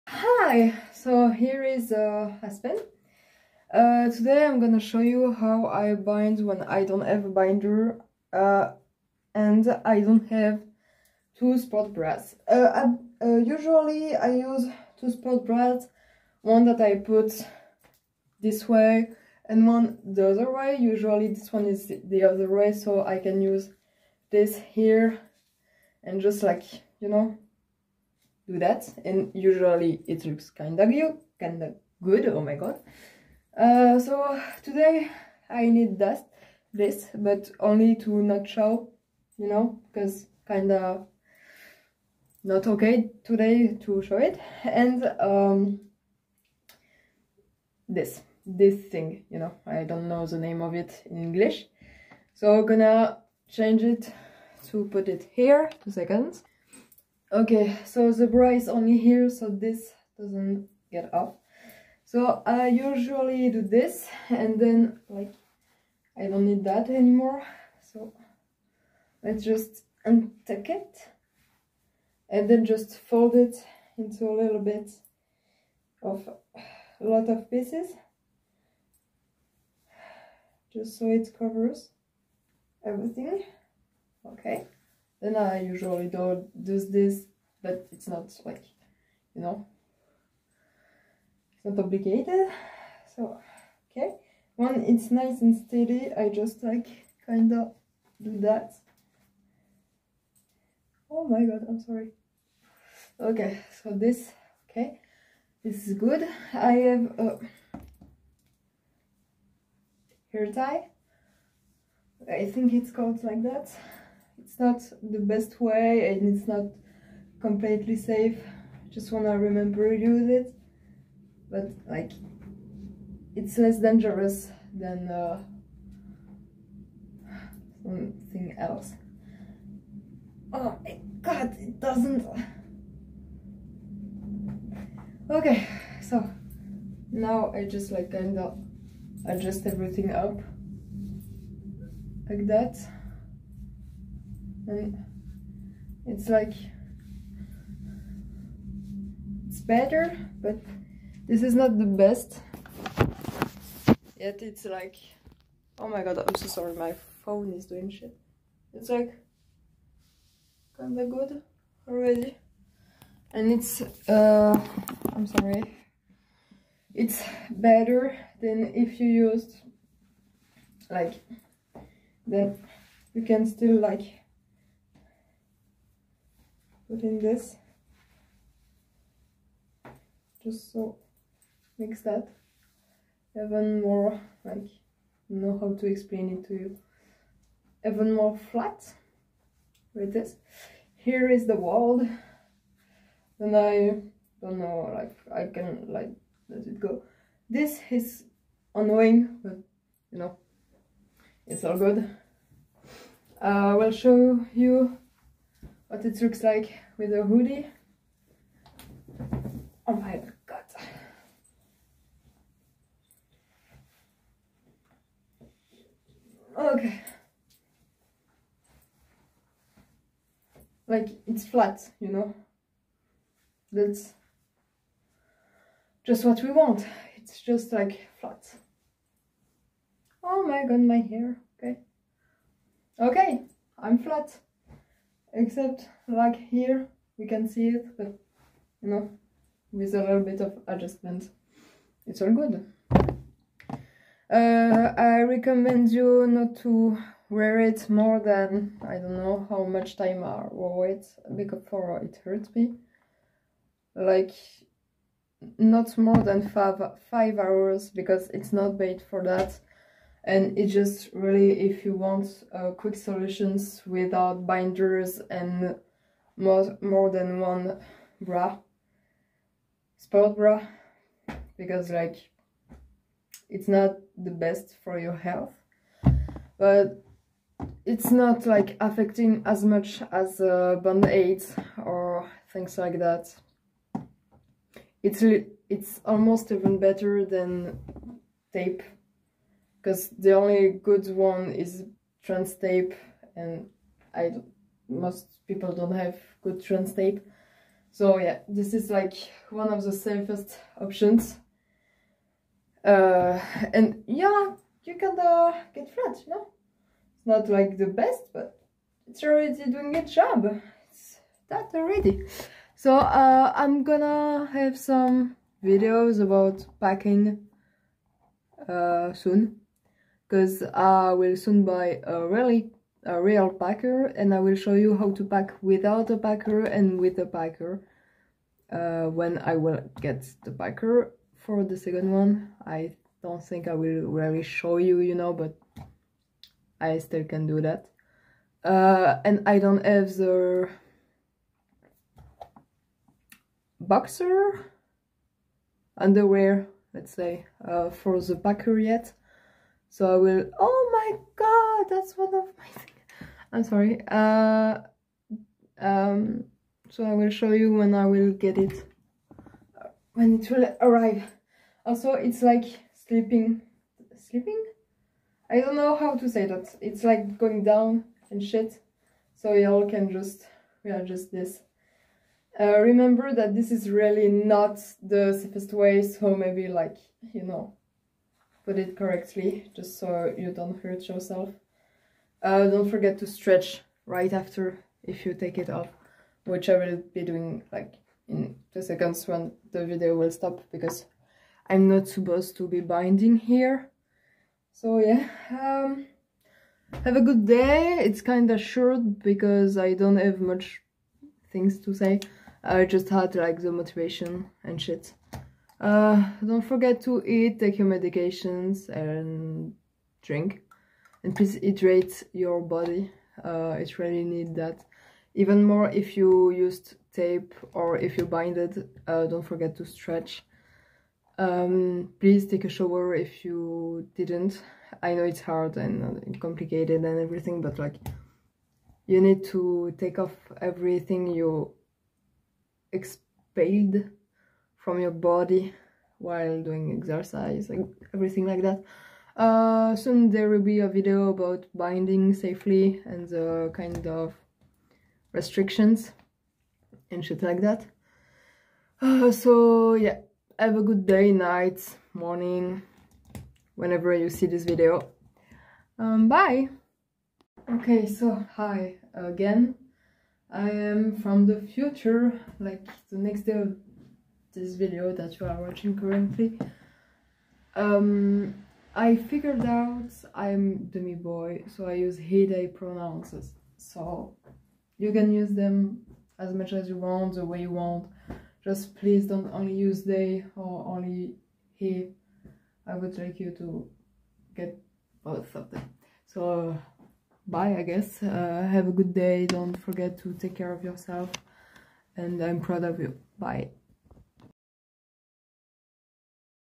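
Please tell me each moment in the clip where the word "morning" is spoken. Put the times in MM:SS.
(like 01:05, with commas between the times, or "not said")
07:32.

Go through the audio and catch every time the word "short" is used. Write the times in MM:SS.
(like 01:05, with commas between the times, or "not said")
06:38.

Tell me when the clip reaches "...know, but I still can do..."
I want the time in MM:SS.
05:35.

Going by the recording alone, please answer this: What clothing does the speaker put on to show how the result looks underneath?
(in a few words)
a hoodie.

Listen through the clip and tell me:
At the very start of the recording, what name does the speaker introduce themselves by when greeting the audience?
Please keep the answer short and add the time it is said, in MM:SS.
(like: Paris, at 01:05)
Aspen, at 00:02.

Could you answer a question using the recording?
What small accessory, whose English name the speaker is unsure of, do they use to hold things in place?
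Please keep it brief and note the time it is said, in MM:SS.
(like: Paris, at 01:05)
hair tie, at 01:50.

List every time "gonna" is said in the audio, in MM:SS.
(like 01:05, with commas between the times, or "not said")
00:04, 00:52, 05:13.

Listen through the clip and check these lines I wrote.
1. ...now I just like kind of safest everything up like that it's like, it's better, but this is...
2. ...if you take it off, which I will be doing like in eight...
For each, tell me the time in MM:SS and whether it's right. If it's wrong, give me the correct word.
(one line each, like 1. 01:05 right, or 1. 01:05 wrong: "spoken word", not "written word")
1. 02:17 wrong: "adjust", not "safest"
2. 06:25 wrong: "two", not "eight".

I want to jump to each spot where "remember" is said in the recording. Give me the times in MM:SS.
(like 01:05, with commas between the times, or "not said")
01:59, 06:12.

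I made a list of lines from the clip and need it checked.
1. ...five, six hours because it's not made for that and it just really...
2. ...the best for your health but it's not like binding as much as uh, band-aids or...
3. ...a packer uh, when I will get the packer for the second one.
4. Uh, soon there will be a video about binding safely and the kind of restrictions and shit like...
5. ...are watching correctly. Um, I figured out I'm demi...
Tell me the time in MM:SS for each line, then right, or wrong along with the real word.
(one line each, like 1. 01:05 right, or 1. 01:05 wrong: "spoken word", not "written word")
1. 04:16 wrong: "five", not "six"
2. 04:34 wrong: "affecting", not "binding"
3. 05:27 right
4. 07:19 right
5. 07:45 wrong: "currently", not "correctly".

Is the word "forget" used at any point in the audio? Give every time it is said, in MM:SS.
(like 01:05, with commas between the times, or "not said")
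06:22, 06:46, 06:59, 08:09.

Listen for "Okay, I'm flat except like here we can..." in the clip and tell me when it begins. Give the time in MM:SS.
03:52.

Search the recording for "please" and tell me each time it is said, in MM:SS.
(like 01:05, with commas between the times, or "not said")
06:51, 07:02, 07:58.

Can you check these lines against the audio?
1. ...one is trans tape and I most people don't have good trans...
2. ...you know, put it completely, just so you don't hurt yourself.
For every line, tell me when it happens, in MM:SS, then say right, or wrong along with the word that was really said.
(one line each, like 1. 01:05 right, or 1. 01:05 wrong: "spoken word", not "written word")
1. 04:51 right
2. 06:17 wrong: "correctly", not "completely".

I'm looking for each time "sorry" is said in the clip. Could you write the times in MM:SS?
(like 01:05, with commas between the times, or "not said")
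01:41, 02:36, 02:45, 05:53.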